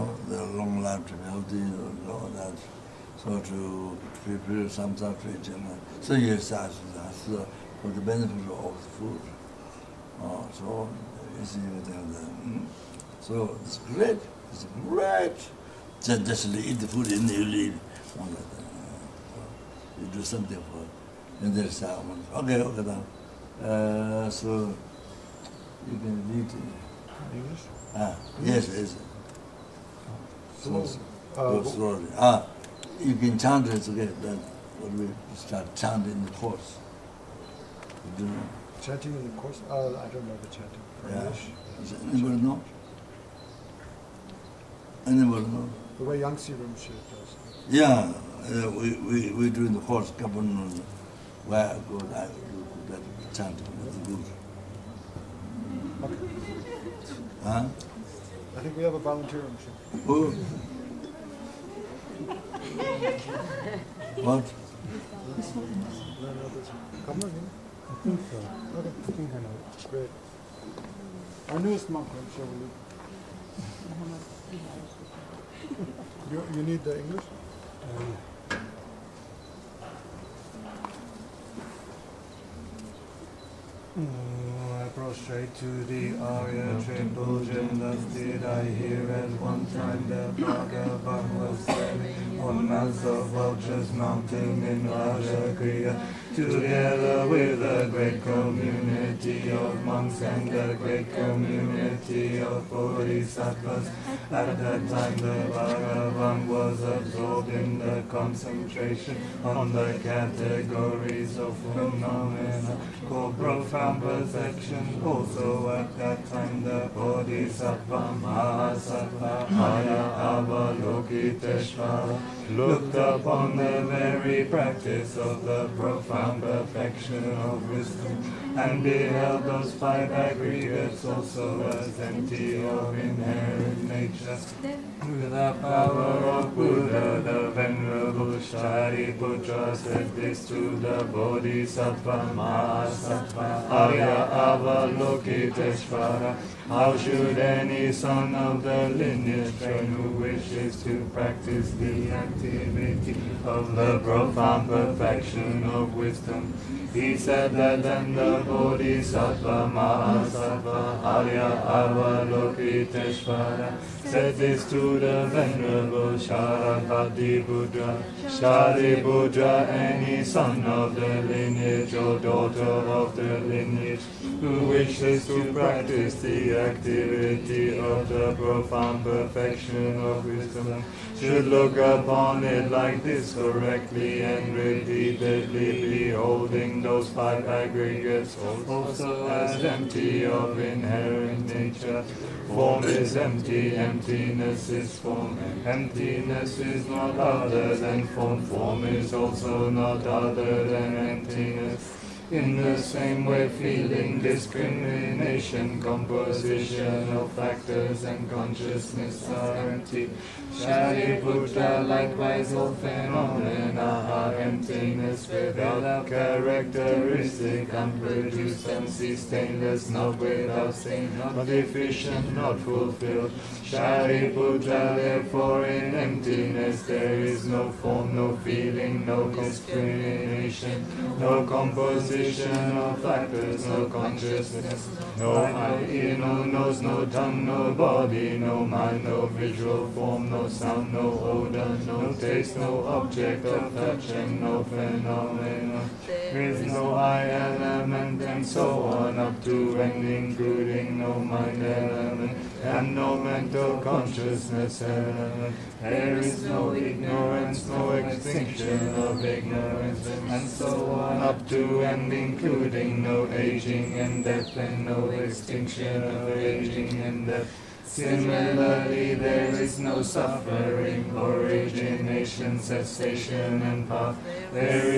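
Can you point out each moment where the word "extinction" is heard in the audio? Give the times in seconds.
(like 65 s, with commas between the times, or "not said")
258 s, 265 s.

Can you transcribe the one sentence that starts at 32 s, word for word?
Ah, you can chant it together, then we start chanting the course.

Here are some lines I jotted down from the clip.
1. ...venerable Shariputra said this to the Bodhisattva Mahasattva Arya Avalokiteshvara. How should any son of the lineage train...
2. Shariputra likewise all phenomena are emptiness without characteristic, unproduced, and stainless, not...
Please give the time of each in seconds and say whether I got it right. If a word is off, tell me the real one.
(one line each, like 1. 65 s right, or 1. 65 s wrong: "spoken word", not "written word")
1. 137 s right
2. 210 s right.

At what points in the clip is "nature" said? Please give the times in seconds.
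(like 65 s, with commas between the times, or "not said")
133 s, 191 s.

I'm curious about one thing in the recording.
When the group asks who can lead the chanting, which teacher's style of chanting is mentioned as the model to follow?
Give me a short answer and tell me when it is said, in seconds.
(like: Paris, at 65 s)
Yangsi Rinpoche, at 46 s.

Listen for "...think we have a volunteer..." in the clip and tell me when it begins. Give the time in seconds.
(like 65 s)
58 s.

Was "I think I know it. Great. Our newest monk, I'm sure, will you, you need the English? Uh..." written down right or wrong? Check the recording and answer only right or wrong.
right.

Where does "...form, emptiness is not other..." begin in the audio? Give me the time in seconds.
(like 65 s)
194 s.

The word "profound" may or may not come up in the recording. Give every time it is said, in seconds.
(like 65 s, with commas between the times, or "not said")
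113 s, 125 s, 153 s, 178 s.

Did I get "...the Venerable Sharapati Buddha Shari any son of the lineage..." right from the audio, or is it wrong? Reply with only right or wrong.
right.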